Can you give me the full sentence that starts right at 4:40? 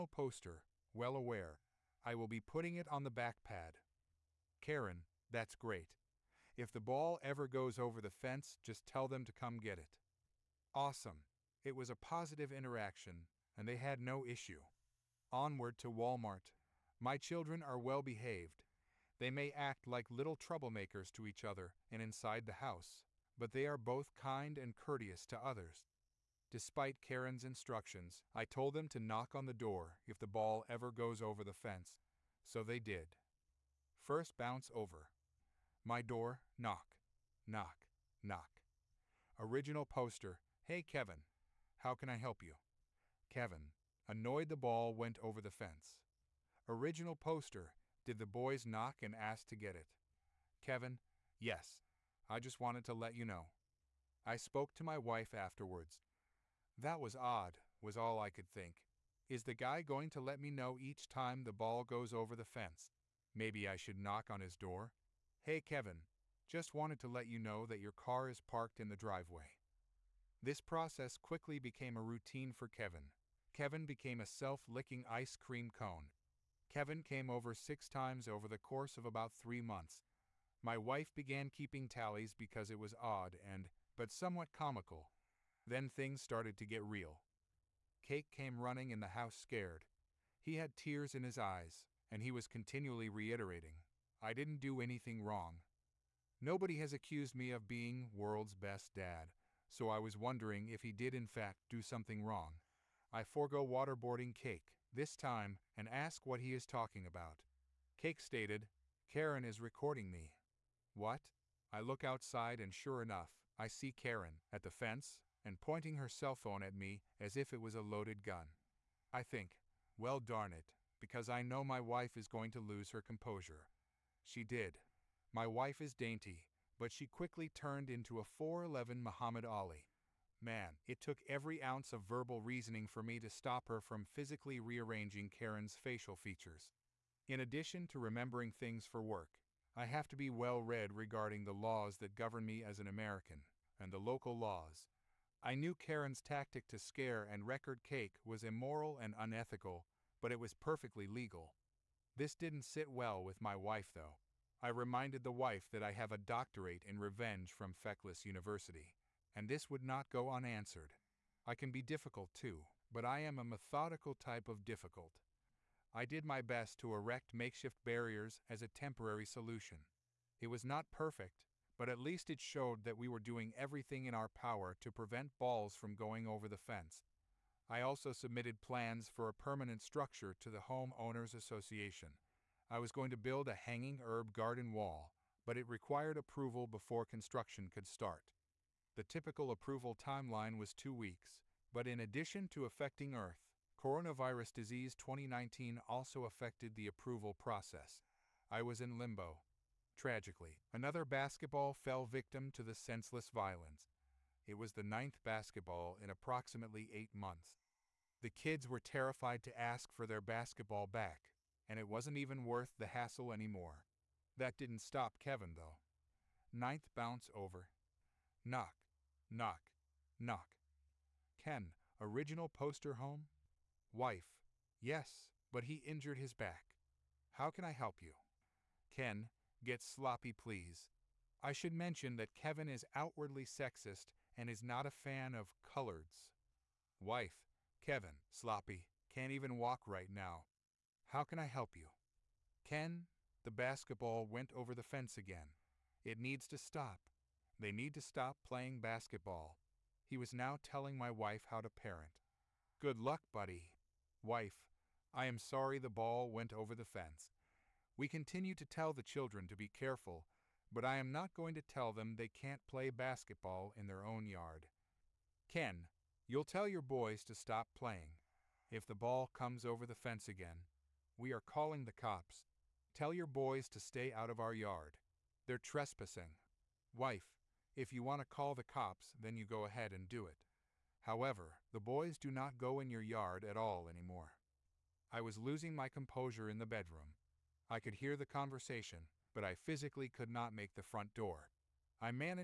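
However, the boys do not go in your yard at all anymore.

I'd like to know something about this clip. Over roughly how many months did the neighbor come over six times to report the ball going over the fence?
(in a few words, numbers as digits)
3.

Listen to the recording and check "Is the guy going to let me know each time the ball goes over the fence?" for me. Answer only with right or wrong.
right.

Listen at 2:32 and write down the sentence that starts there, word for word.
This didn't sit well with my wife, though.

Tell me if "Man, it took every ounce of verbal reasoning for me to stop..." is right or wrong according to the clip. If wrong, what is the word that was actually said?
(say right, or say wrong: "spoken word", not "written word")
right.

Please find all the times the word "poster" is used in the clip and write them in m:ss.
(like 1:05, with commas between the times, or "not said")
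0:00, 0:39, 0:47, 3:42.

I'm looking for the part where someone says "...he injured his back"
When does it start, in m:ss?
3:45.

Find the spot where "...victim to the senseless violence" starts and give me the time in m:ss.
3:22.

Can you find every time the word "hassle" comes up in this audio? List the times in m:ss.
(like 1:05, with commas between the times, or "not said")
3:32.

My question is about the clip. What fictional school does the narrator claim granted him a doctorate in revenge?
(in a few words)
Feckless University.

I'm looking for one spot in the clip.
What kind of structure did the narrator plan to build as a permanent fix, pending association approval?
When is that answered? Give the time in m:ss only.
3:03.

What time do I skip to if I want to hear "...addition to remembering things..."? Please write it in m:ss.
2:17.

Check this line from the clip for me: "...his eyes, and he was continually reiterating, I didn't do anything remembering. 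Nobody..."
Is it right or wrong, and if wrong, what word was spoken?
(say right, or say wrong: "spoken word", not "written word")
wrong: "wrong", not "remembering".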